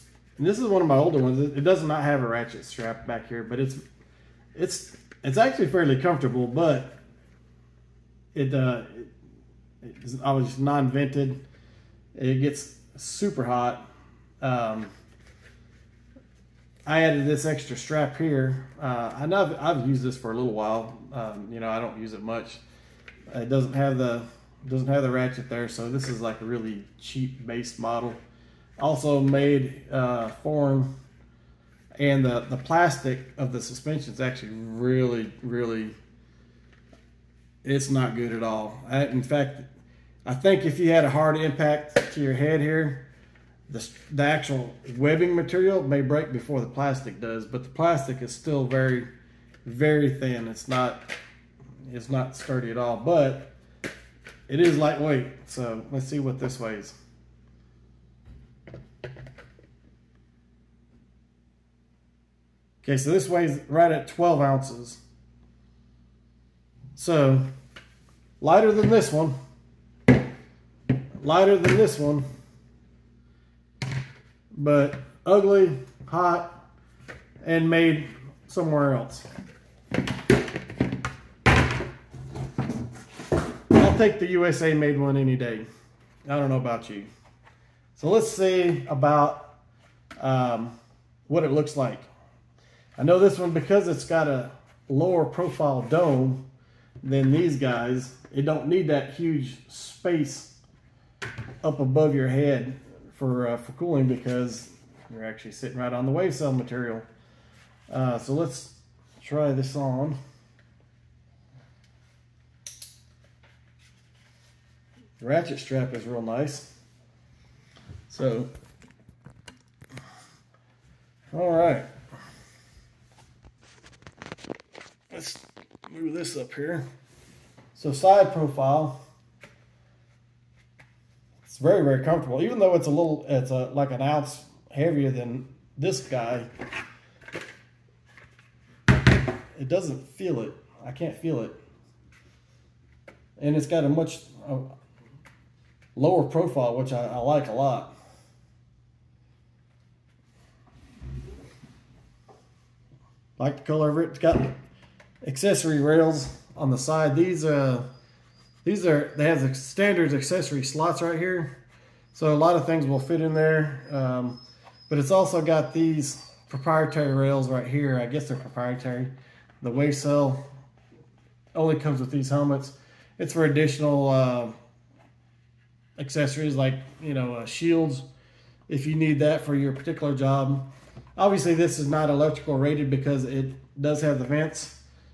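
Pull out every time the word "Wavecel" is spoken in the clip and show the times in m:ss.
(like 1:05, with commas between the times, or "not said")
1:46, 2:49.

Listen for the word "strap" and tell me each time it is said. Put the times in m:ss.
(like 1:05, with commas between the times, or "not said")
0:02, 0:17, 1:55.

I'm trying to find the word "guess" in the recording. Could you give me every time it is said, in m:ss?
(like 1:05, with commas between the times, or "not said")
2:48.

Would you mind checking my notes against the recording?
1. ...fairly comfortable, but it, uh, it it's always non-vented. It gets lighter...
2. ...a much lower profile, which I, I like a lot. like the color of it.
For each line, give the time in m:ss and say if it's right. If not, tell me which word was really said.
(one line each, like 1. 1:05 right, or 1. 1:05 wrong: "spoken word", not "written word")
1. 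0:05 wrong: "super", not "lighter"
2. 2:23 right.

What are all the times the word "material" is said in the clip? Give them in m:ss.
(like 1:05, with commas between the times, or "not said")
0:45, 1:46.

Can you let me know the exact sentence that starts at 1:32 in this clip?
I know this one because it's got a lower profile dome than these guys.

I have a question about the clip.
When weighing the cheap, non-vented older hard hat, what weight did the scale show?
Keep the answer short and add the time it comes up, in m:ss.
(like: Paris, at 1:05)
12 ounces, at 1:04.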